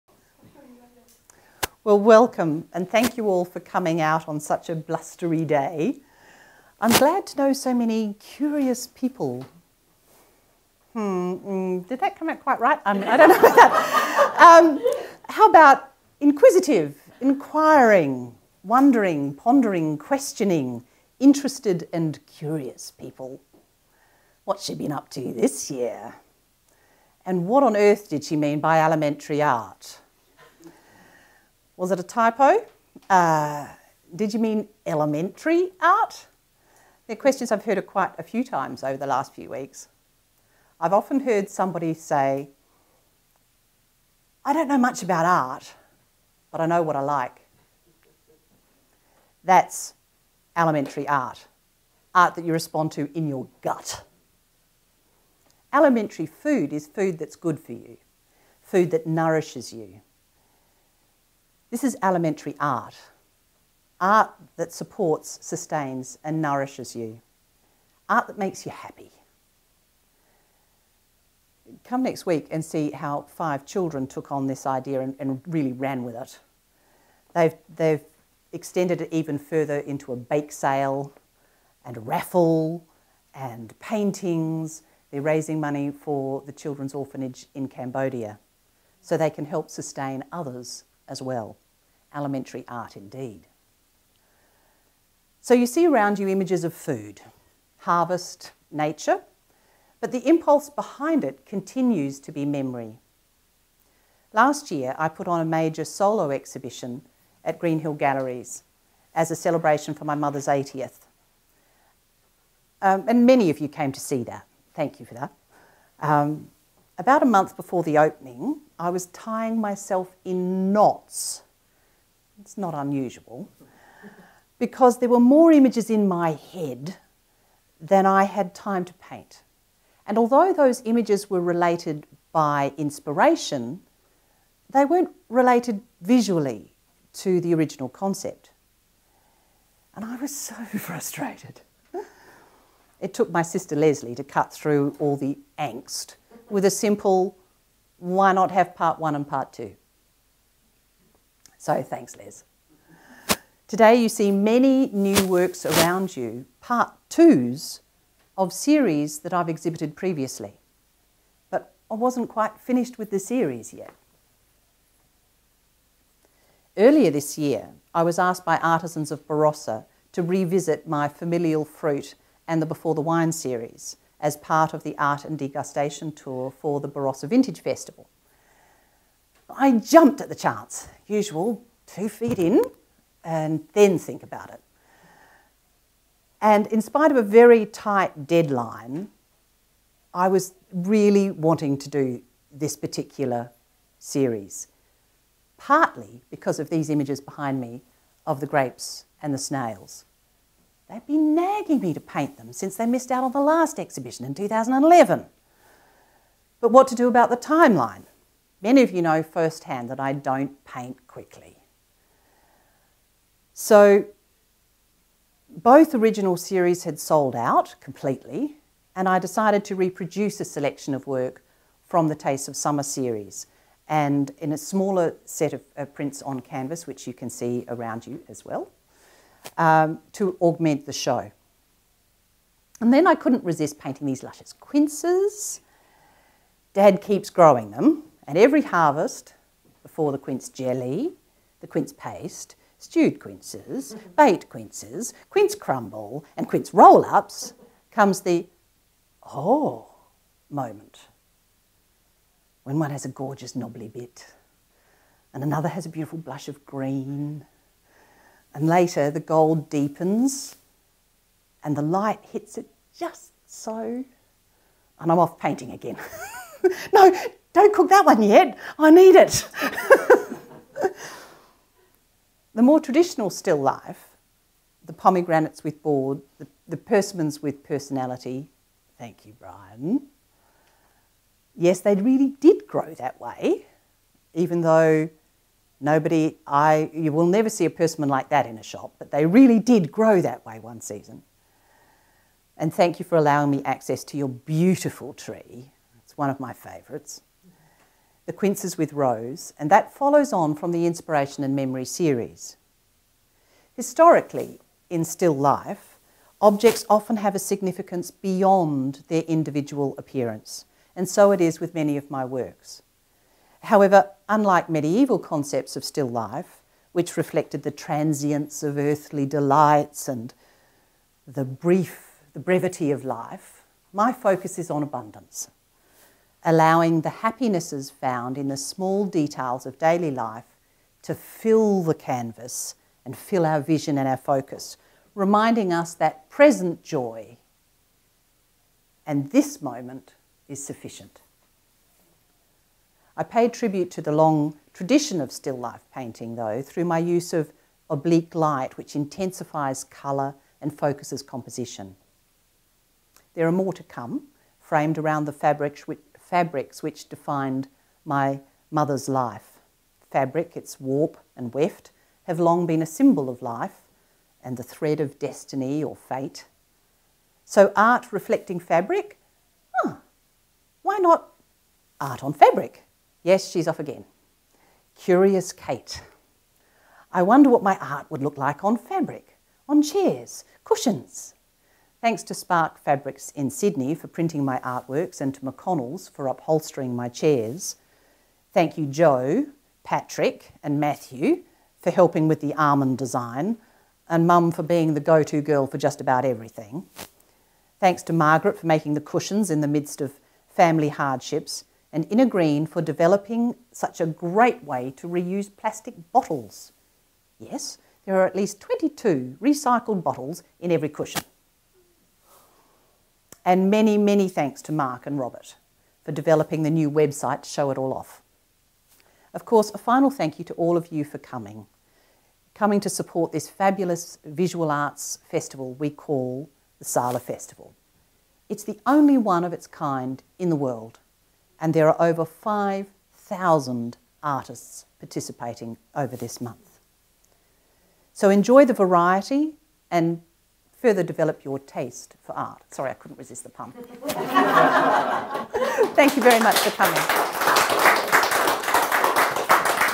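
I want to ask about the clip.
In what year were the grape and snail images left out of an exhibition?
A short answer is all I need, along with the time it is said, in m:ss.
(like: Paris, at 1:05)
2011, at 3:24.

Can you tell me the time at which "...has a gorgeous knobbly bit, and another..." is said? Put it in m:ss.
4:12.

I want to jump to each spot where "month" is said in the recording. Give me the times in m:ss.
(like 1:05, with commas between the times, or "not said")
1:57, 7:16.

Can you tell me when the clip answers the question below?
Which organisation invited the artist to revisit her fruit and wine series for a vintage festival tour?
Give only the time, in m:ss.
2:48.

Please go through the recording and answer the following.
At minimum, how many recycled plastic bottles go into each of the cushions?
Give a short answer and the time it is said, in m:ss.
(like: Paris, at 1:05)
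22, at 6:48.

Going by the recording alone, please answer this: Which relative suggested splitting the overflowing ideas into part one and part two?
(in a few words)
Leslie.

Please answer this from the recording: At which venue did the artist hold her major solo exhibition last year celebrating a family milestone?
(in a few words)
Greenhill Galleries.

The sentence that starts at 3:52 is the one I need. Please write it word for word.
And then I couldn't resist painting these luscious quinces.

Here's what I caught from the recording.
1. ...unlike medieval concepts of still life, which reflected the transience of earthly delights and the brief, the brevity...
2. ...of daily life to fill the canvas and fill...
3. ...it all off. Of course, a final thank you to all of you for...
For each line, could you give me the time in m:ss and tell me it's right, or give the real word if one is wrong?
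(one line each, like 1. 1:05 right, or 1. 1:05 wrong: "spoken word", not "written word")
1. 5:14 right
2. 5:29 right
3. 6:57 right.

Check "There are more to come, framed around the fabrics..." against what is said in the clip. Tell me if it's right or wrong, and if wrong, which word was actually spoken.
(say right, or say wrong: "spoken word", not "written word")
right.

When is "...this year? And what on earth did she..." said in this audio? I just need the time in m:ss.
0:25.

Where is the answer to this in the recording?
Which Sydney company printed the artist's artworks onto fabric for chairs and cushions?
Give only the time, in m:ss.
6:22.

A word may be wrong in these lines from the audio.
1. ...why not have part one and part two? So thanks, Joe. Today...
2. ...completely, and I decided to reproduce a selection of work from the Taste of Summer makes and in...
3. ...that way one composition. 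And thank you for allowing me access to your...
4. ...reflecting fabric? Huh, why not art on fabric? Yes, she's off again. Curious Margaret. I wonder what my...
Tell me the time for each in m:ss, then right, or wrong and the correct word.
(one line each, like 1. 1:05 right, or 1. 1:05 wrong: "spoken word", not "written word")
1. 2:27 wrong: "Les", not "Joe"
2. 3:37 wrong: "series", not "makes"
3. 4:50 wrong: "season", not "composition"
4. 6:08 wrong: "Kate", not "Margaret".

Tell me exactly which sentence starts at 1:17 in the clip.
They've, they've extended it even further into a bake sale and raffle and paintings.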